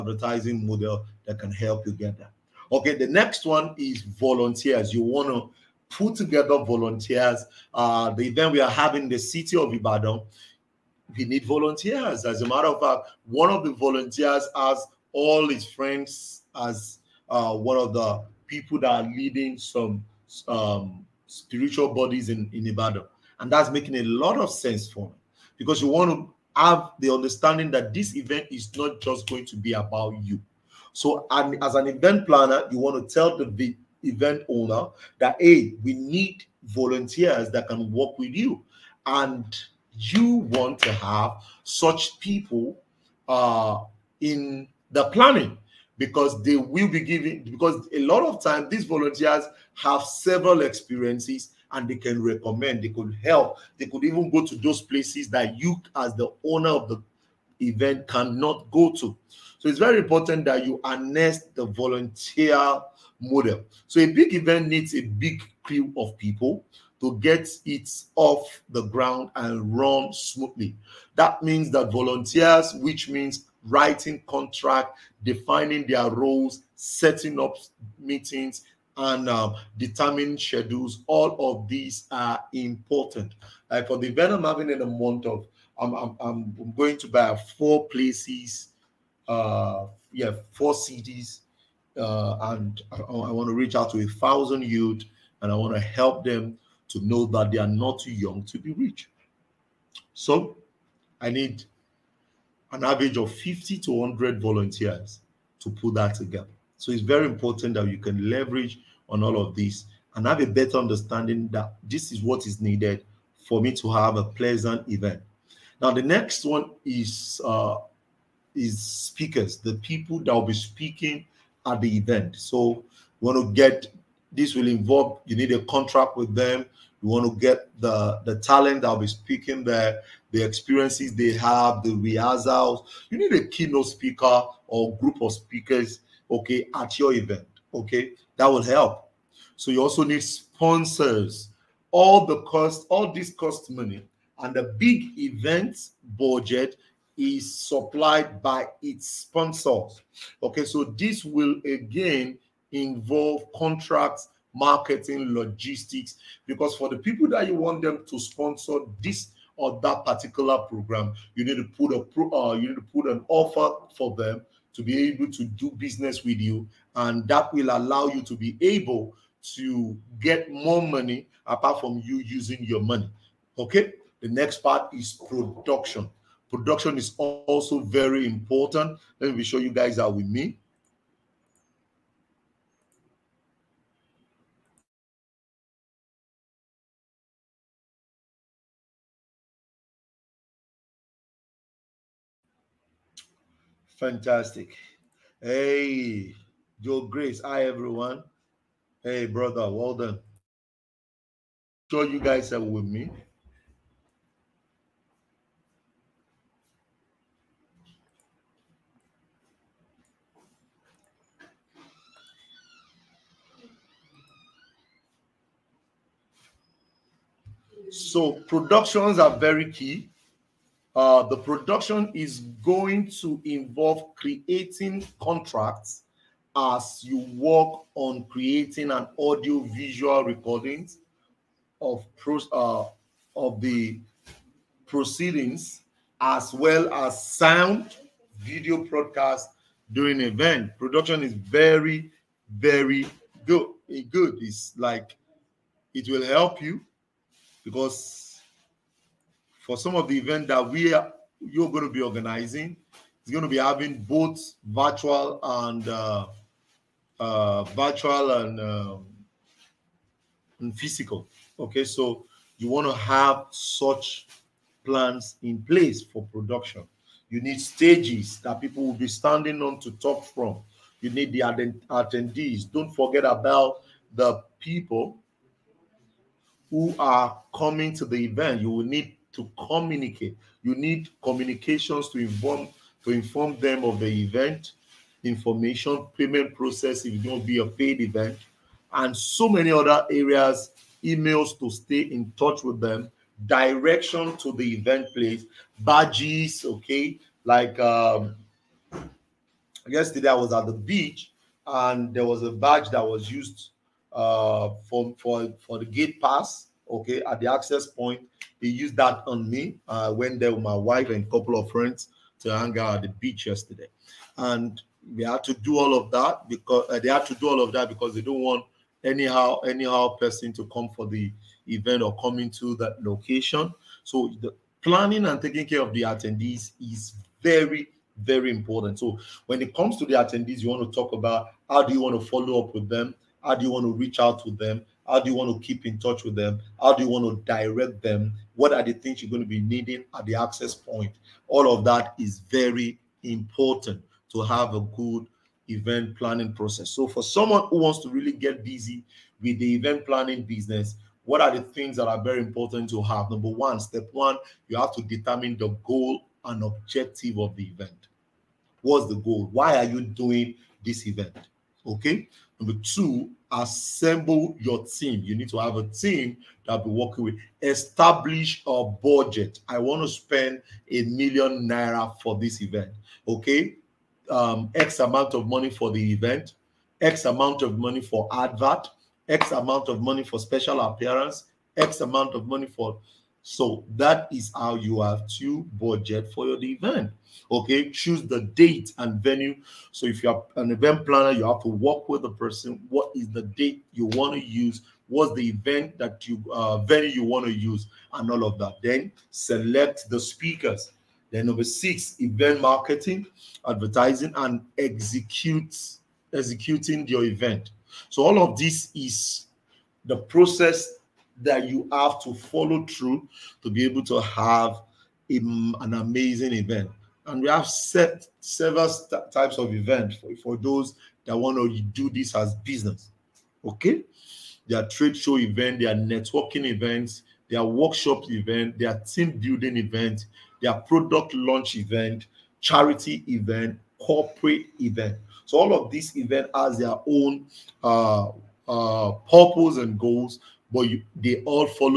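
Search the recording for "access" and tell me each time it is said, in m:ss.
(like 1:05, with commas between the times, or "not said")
5:07, 5:40.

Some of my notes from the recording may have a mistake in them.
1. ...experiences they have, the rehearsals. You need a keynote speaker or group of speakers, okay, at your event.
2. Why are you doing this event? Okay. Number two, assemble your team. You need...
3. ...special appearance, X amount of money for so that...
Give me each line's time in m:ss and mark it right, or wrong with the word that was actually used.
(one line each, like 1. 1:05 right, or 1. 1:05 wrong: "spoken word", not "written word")
1. 2:10 right
2. 5:59 right
3. 6:20 right.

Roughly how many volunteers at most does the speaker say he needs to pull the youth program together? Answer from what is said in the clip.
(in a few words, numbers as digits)
100.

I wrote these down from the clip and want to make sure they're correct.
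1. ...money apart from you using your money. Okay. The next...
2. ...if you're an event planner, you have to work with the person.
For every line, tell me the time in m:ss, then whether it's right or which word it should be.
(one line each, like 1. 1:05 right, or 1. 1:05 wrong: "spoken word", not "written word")
1. 2:50 right
2. 6:30 right.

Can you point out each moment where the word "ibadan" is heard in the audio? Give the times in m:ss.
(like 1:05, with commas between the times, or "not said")
0:09, 0:22.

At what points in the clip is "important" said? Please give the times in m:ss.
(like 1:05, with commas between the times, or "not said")
0:59, 1:22, 1:47, 2:58, 5:28, 5:43, 5:52.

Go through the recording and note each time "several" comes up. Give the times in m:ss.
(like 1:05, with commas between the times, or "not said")
0:50, 6:58.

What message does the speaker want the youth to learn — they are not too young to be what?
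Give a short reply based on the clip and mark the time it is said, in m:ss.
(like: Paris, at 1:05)
rich, at 1:38.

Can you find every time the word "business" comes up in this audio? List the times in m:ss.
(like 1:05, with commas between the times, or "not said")
2:45, 5:50, 7:02.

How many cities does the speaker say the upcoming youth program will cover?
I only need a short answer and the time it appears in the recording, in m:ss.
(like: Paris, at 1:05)
4, at 1:30.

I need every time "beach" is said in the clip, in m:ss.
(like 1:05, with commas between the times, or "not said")
5:00, 5:13.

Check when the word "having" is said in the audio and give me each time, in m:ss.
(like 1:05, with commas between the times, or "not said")
0:08, 1:24, 4:13.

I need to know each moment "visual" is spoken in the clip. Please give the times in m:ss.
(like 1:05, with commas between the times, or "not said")
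3:49.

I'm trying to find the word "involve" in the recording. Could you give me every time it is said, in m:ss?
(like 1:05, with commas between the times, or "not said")
2:04, 2:32, 3:43.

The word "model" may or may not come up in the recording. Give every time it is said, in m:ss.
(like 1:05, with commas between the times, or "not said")
0:00, 1:03.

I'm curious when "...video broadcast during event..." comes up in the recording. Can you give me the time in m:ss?
3:58.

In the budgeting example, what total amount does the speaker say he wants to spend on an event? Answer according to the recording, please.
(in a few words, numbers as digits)
a million naira.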